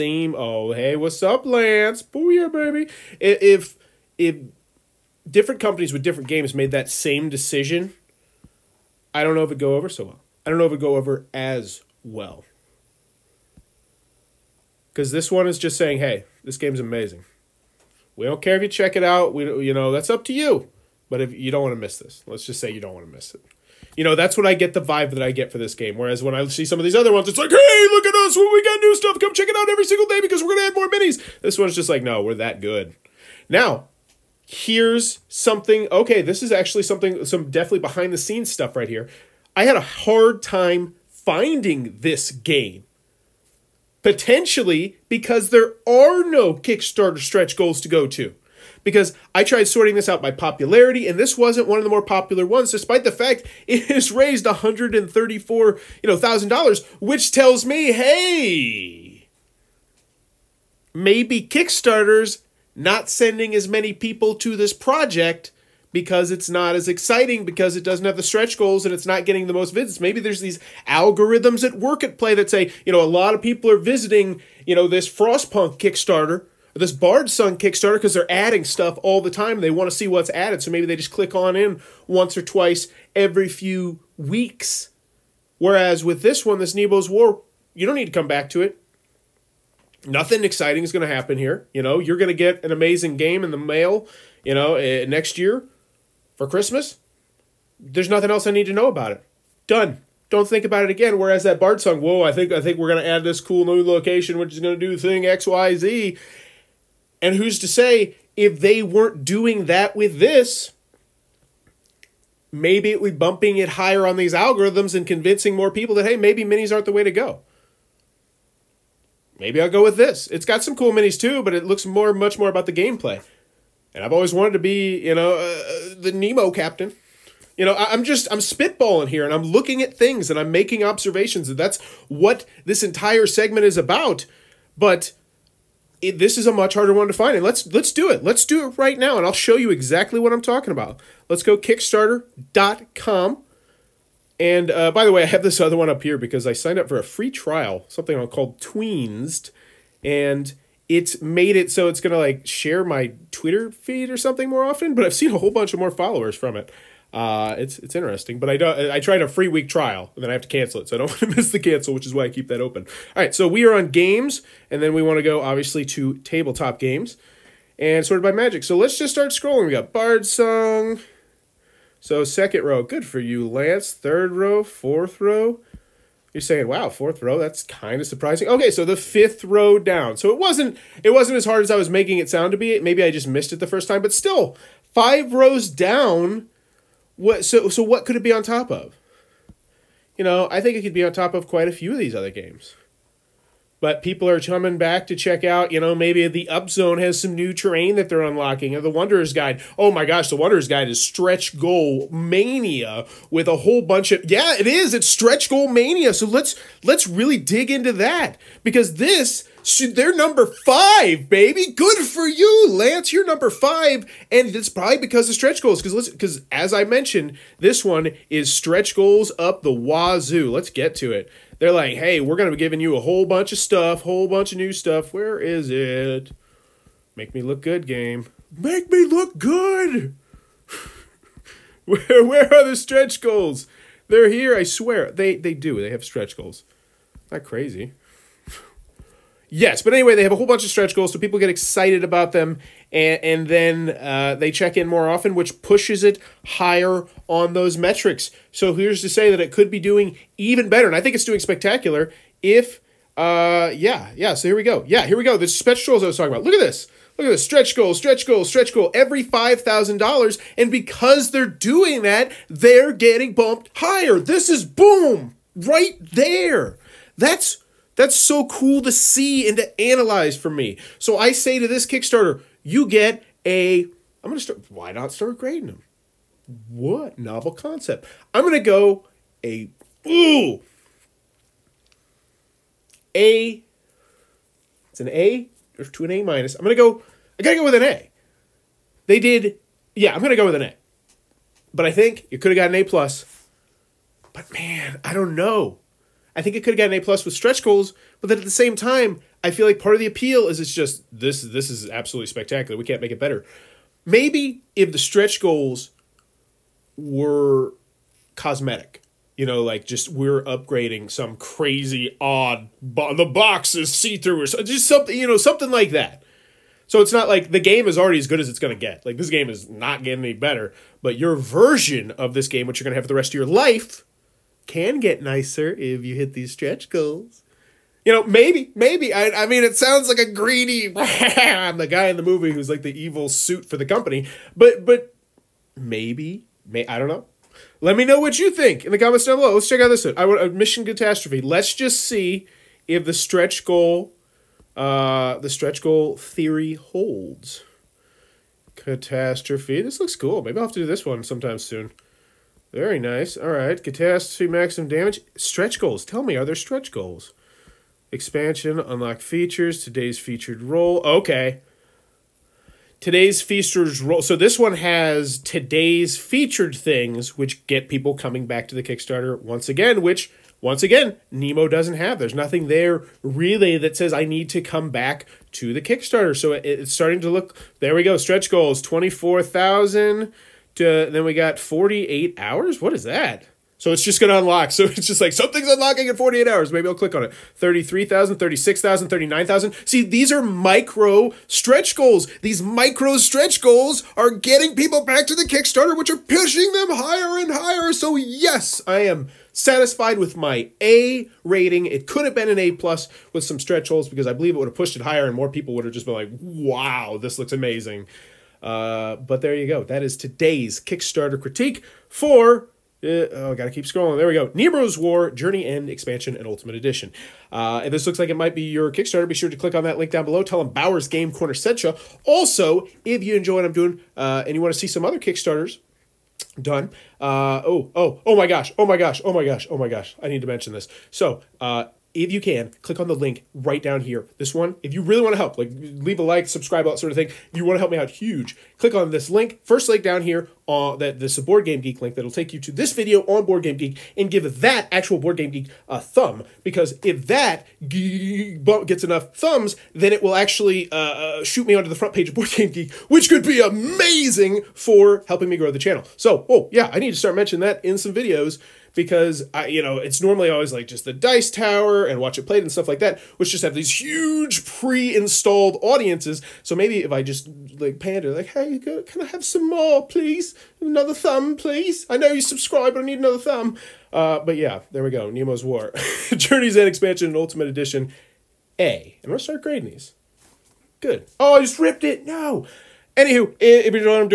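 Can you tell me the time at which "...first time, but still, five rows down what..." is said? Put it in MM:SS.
03:03.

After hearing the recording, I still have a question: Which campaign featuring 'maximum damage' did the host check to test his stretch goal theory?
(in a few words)
Mission Catastrophe.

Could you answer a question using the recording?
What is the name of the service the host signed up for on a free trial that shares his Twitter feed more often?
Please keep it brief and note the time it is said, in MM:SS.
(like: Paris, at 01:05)
Tweensed, at 02:28.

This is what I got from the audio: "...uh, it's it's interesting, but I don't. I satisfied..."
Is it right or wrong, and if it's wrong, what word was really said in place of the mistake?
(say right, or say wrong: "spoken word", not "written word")
wrong: "tried", not "satisfied".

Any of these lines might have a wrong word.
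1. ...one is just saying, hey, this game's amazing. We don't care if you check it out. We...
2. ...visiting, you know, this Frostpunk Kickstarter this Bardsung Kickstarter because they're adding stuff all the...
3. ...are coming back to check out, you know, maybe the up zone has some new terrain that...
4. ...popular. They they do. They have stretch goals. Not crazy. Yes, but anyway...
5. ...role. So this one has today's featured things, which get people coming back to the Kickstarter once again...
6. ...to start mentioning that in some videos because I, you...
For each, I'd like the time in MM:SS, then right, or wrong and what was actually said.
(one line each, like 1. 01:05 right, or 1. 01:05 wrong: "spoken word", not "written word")
1. 00:15 right
2. 01:13 right
3. 03:14 right
4. 03:54 wrong: "swear", not "popular"
5. 06:04 right
6. 07:37 right.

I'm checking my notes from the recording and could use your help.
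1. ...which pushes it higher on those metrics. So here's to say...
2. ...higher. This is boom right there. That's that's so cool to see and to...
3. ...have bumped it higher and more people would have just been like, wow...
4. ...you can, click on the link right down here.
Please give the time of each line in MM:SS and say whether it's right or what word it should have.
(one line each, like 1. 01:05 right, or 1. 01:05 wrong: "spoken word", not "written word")
1. 04:05 right
2. 04:23 right
3. 06:44 wrong: "pushed", not "bumped"
4. 07:12 right.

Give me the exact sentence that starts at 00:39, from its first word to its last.
I had a hard time finding this game.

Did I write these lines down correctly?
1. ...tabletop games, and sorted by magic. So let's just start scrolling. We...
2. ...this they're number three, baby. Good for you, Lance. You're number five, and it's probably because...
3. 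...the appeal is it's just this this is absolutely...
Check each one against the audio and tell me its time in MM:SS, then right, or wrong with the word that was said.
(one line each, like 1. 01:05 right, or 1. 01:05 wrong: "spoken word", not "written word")
1. 02:46 right
2. 03:28 wrong: "five", not "three"
3. 04:59 right.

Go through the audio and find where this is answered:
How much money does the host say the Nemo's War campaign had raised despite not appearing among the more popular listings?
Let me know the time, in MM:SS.
00:54.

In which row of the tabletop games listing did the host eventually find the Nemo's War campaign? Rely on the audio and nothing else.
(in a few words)
Fifth row.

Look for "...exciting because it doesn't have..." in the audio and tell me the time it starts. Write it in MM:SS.
01:06.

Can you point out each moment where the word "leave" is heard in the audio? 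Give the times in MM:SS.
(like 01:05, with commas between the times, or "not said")
07:15.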